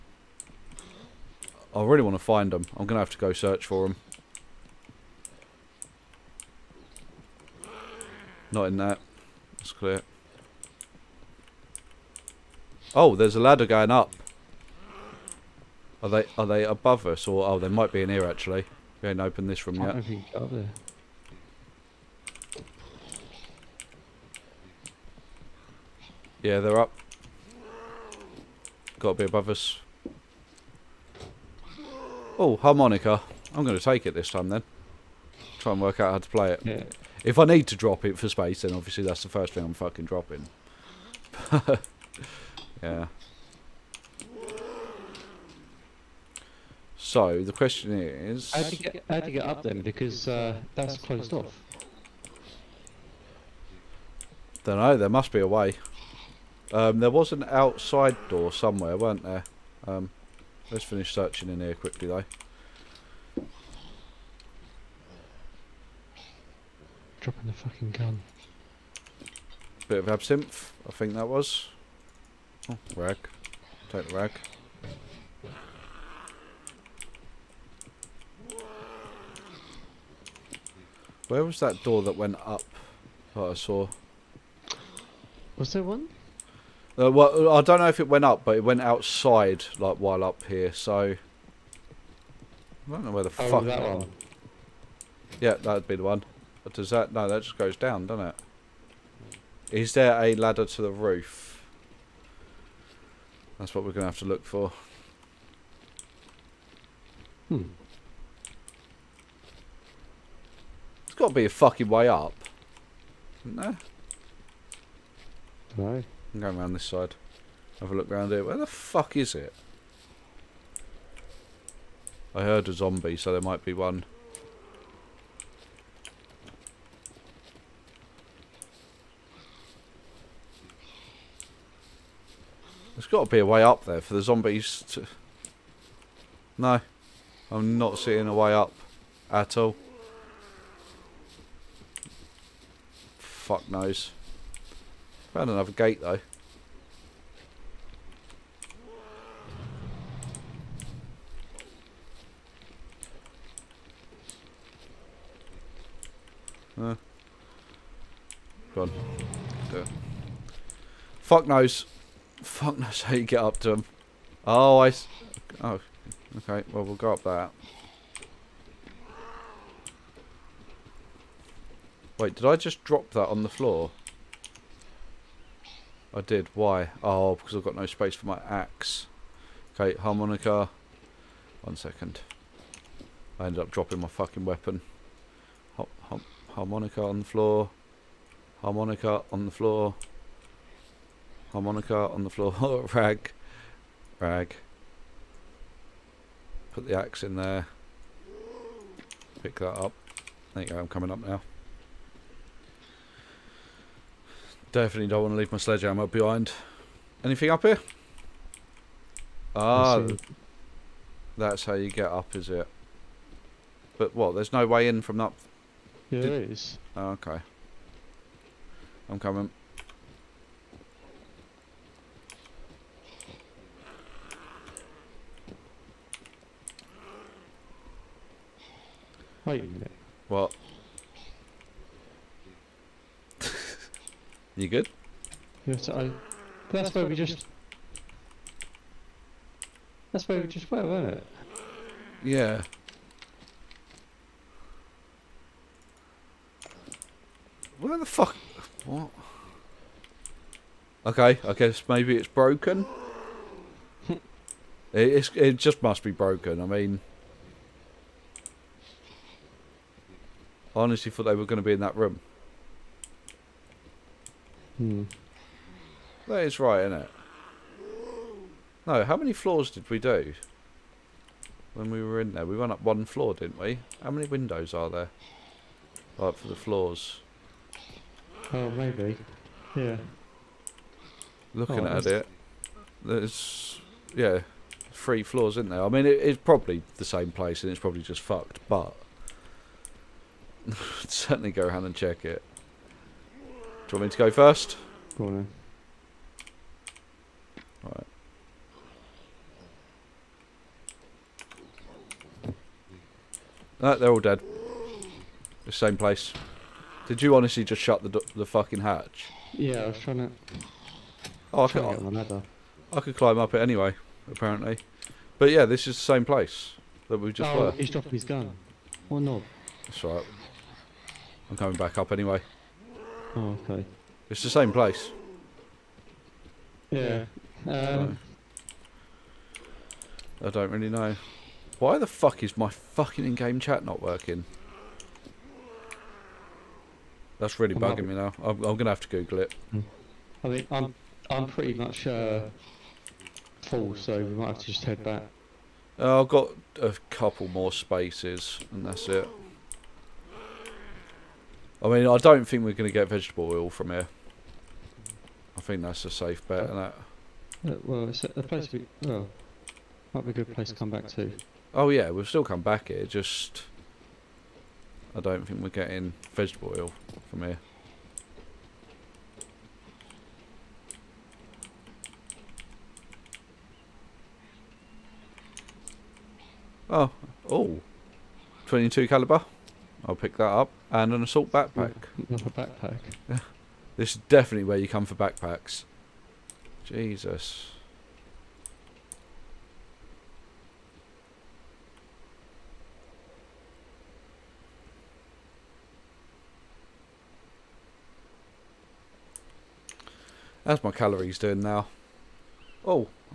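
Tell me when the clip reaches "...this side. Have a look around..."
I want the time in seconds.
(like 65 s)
116 s.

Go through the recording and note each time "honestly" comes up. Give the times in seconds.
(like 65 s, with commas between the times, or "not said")
260 s, 307 s.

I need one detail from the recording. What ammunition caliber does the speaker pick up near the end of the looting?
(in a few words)
22 caliber.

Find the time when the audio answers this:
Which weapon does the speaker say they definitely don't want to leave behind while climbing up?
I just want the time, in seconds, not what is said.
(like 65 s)
205 s.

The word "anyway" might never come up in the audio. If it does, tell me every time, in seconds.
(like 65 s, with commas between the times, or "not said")
313 s, 322 s.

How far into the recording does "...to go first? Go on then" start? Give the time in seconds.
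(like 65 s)
294 s.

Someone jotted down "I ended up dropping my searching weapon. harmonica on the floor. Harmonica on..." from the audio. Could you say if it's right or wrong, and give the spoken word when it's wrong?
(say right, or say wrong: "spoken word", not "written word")
wrong: "fucking", not "searching".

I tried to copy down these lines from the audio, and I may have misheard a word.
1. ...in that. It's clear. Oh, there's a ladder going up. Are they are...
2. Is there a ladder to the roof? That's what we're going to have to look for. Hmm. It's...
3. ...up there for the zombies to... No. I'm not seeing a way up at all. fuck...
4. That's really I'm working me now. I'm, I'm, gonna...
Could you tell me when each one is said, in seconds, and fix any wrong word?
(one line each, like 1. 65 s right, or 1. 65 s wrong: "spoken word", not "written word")
1. 8 s right
2. 99 s right
3. 133 s right
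4. 337 s wrong: "bugging", not "working".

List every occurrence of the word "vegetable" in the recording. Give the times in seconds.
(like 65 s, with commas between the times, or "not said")
353 s, 366 s.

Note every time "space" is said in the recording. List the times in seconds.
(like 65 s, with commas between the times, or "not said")
38 s, 177 s, 347 s.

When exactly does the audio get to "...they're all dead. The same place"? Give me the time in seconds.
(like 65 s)
303 s.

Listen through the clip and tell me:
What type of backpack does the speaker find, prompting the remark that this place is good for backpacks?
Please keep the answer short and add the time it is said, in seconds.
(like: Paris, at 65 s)
assault backpack, at 381 s.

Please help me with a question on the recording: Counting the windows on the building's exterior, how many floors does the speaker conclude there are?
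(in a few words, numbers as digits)
3.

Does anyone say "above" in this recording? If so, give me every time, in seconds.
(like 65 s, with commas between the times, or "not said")
16 s, 29 s.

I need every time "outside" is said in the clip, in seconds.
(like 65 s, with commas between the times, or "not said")
57 s, 88 s.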